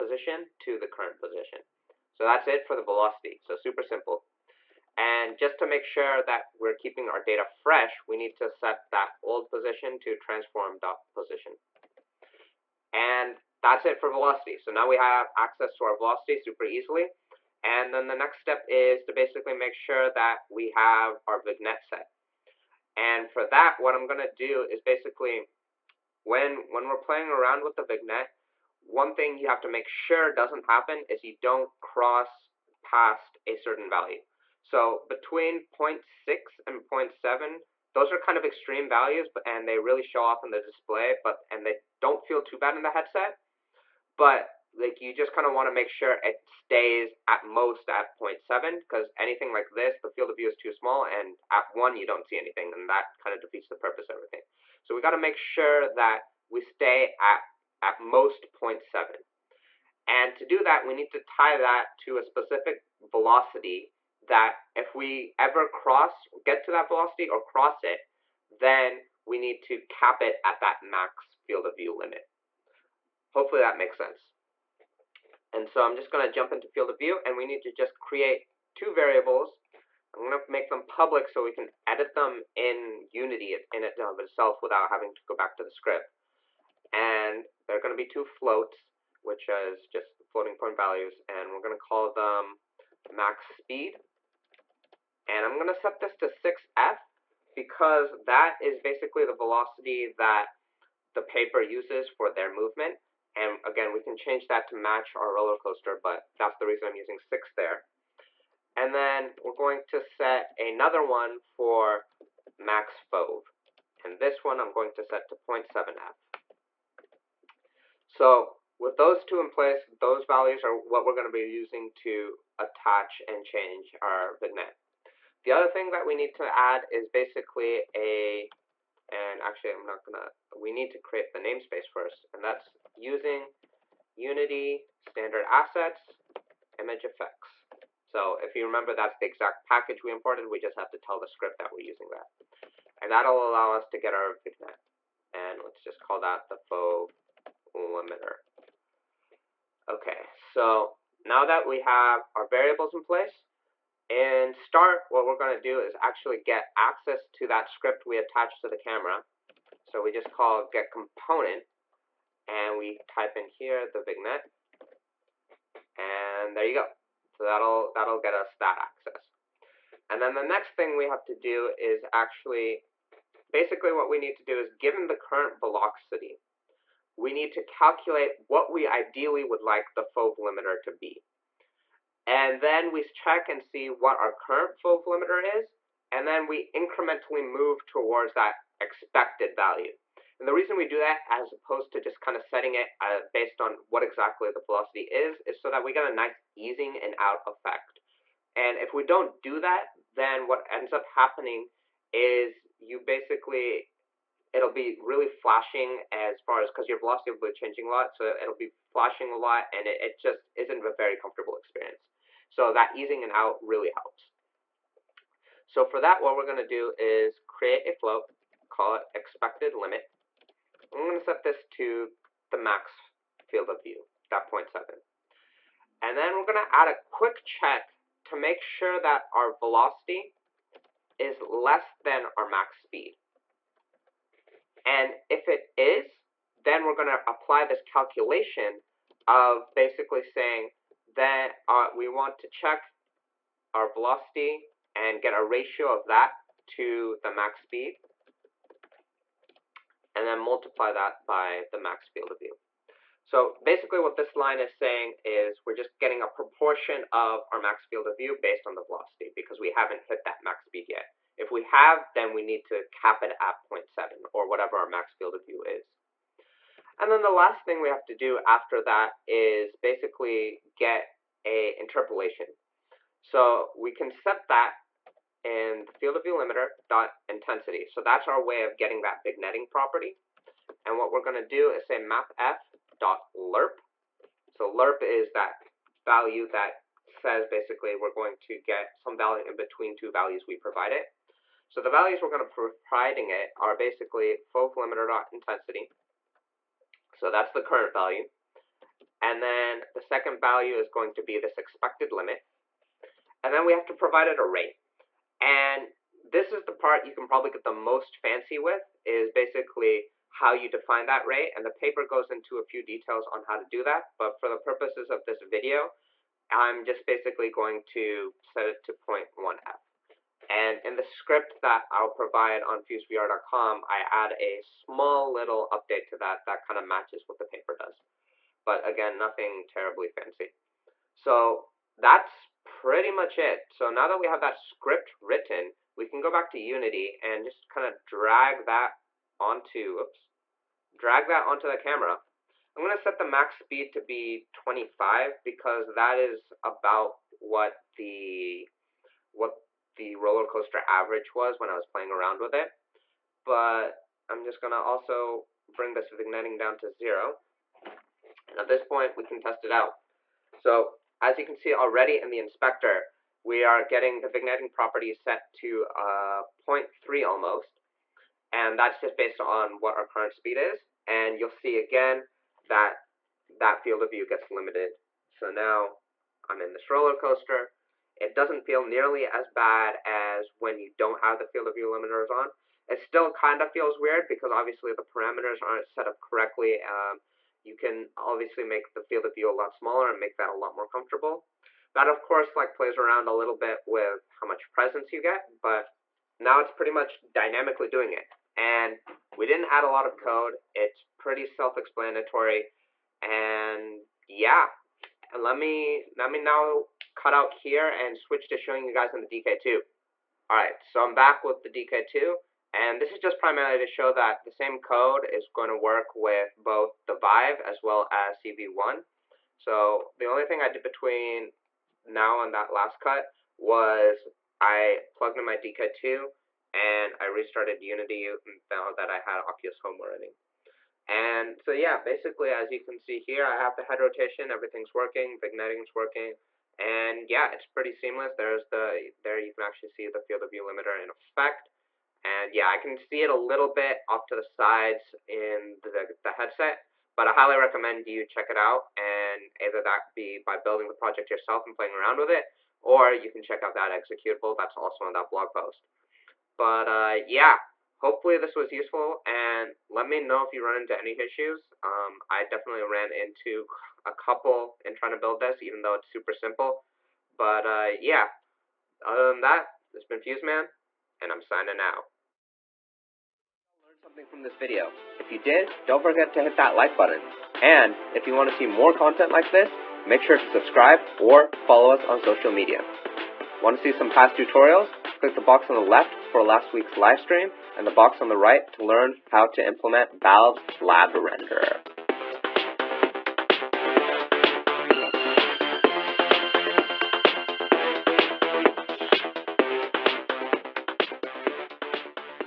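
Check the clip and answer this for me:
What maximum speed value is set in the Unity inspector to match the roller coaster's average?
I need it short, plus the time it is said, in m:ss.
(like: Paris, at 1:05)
25, at 5:44.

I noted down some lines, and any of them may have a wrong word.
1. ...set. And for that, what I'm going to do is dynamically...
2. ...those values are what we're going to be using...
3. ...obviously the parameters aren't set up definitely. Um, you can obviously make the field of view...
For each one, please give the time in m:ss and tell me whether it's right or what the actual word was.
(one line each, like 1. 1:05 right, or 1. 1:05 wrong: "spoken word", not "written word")
1. 0:21 wrong: "basically", not "dynamically"
2. 2:00 right
3. 6:24 wrong: "correctly", not "definitely".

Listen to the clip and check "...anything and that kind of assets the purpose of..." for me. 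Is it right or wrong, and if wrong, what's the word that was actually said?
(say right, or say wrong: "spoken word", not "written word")
wrong: "defeats", not "assets".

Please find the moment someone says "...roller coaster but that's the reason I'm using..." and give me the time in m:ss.
1:45.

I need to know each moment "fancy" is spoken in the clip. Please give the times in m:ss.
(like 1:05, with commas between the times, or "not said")
5:08, 5:30.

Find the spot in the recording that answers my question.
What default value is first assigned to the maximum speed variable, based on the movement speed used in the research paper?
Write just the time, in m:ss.
1:36.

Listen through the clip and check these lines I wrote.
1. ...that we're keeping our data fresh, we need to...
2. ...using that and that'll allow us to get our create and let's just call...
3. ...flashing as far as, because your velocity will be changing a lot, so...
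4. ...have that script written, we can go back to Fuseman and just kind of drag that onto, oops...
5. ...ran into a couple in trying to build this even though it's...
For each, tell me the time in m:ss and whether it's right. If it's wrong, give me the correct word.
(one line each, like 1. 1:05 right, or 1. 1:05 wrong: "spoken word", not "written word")
1. 0:06 right
2. 2:21 wrong: "vignette", not "create"
3. 3:25 right
4. 5:34 wrong: "Unity", not "Fuseman"
5. 7:42 right.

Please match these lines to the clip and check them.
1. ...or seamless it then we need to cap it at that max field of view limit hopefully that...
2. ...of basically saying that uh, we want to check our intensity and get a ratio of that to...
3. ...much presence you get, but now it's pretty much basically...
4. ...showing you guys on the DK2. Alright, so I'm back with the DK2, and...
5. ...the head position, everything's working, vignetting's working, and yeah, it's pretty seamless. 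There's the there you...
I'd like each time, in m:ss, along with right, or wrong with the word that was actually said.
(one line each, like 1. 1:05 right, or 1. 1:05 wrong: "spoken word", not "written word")
1. 1:07 wrong: "cross", not "seamless"
2. 3:59 wrong: "velocity", not "intensity"
3. 6:34 wrong: "dynamically", not "basically"
4. 6:48 right
5. 7:13 wrong: "rotation", not "position".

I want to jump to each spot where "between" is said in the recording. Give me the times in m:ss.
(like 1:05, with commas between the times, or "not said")
0:35, 4:49, 7:00.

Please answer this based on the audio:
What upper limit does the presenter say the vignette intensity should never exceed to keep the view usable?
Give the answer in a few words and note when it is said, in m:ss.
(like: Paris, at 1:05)
0.7, at 0:57.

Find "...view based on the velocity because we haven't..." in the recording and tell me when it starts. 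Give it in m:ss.
4:18.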